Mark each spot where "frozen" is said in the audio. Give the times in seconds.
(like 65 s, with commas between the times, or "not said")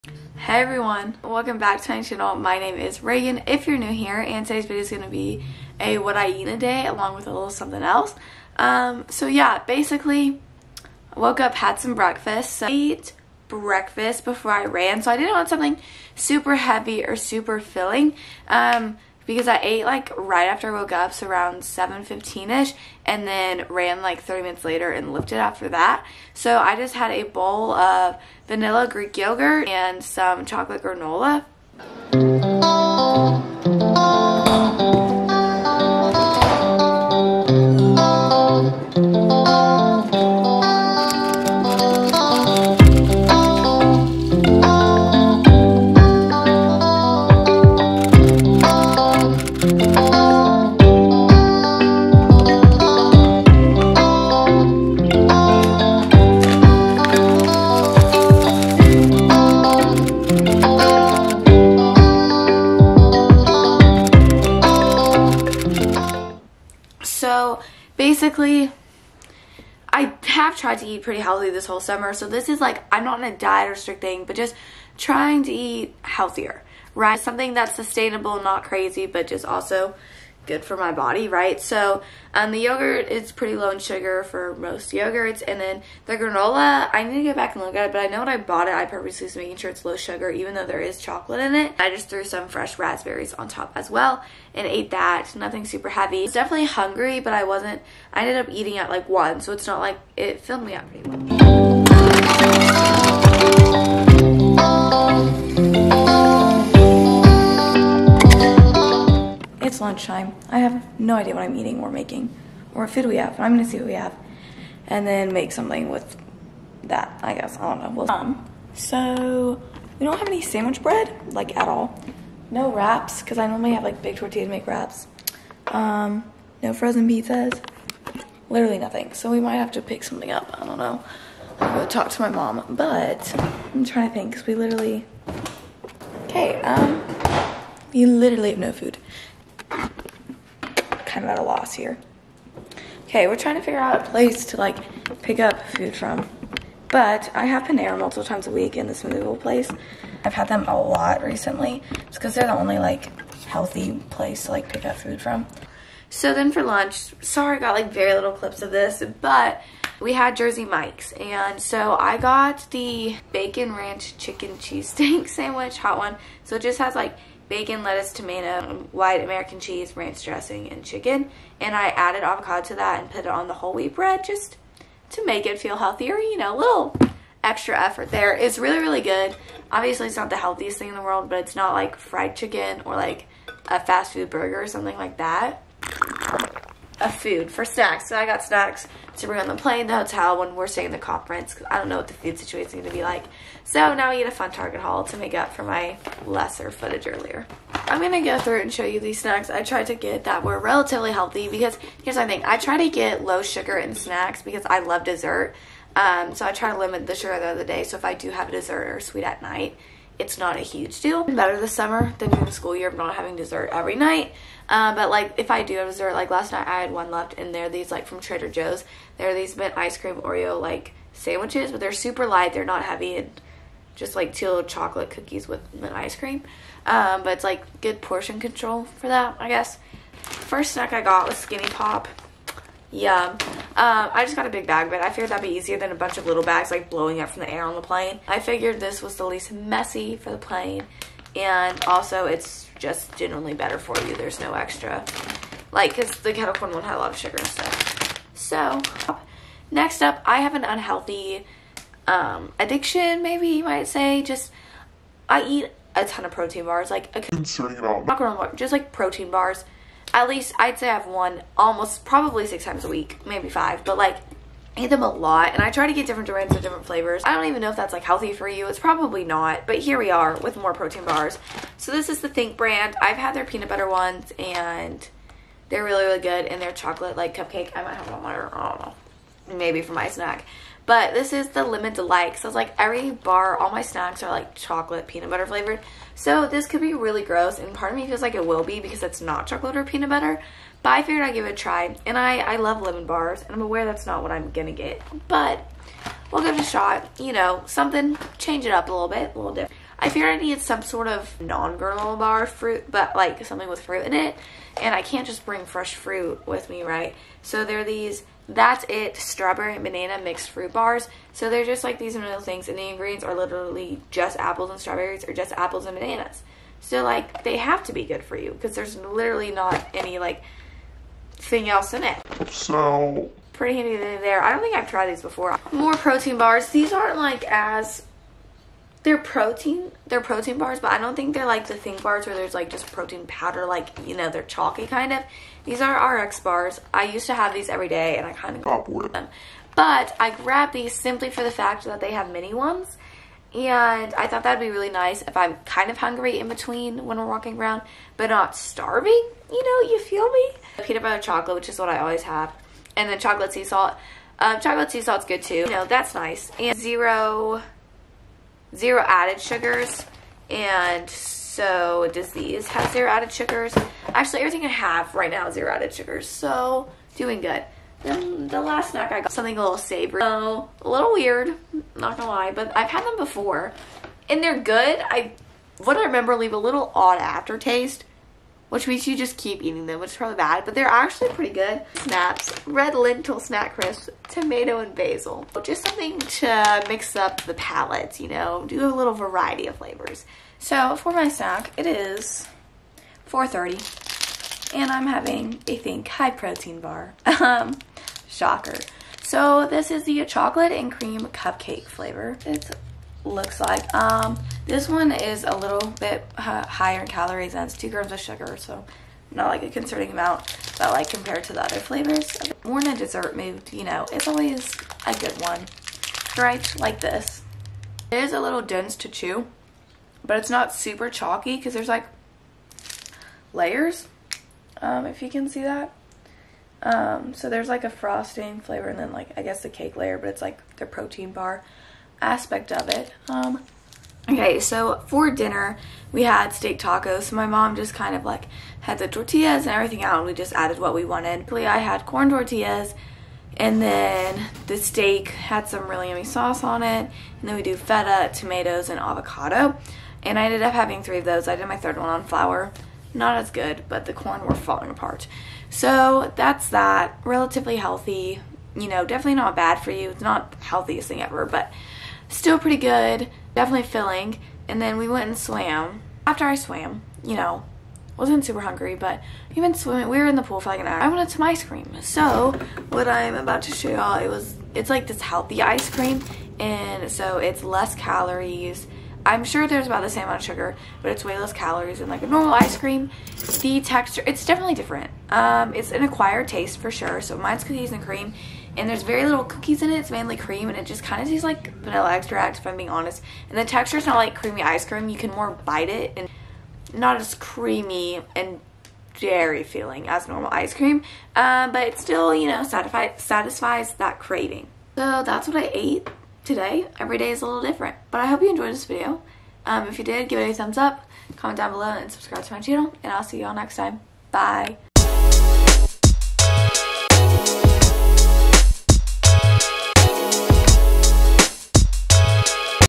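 126 s.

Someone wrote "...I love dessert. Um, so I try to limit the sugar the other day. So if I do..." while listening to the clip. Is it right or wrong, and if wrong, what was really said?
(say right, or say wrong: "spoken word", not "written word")
right.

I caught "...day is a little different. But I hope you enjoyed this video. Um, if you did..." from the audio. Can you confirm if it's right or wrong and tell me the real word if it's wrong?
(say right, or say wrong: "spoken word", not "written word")
right.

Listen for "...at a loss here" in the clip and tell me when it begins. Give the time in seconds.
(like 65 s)
141 s.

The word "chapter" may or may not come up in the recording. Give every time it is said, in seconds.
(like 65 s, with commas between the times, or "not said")
not said.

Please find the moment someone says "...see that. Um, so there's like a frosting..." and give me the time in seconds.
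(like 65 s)
425 s.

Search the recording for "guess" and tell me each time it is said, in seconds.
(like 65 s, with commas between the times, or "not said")
117 s, 229 s, 429 s.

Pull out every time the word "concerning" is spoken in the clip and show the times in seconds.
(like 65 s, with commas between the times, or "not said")
257 s, 409 s.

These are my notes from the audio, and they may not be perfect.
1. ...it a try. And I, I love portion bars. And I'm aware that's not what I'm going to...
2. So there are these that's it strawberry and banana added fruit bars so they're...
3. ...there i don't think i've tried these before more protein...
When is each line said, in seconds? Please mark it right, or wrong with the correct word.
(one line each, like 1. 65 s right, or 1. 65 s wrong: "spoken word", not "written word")
1. 291 s wrong: "lemon", not "portion"
2. 307 s wrong: "mixed", not "added"
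3. 323 s right.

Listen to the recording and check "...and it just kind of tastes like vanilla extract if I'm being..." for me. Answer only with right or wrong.
right.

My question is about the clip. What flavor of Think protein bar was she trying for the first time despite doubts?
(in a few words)
Lemon Delight.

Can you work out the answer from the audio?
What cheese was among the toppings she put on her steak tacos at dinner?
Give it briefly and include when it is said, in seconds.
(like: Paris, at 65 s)
Feta, at 447 s.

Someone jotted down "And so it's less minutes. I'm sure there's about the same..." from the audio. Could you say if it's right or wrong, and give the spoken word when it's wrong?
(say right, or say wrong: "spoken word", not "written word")
wrong: "calories", not "minutes".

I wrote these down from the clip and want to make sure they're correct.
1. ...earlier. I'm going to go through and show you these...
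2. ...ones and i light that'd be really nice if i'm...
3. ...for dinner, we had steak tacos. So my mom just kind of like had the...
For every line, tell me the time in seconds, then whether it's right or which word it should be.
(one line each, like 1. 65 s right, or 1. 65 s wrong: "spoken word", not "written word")
1. 197 s right
2. 342 s wrong: "thought", not "light"
3. 435 s right.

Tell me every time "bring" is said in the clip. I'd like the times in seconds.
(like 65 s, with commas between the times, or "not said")
189 s, 305 s.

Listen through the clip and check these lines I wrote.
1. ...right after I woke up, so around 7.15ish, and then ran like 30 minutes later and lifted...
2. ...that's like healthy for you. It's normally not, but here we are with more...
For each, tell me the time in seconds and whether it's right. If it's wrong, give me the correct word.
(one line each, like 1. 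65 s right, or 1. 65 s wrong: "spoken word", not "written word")
1. 20 s right
2. 267 s wrong: "probably", not "normally".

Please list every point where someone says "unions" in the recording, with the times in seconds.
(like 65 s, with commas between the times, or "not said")
not said.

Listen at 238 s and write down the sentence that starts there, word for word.
I figured this was the least messy for the plane.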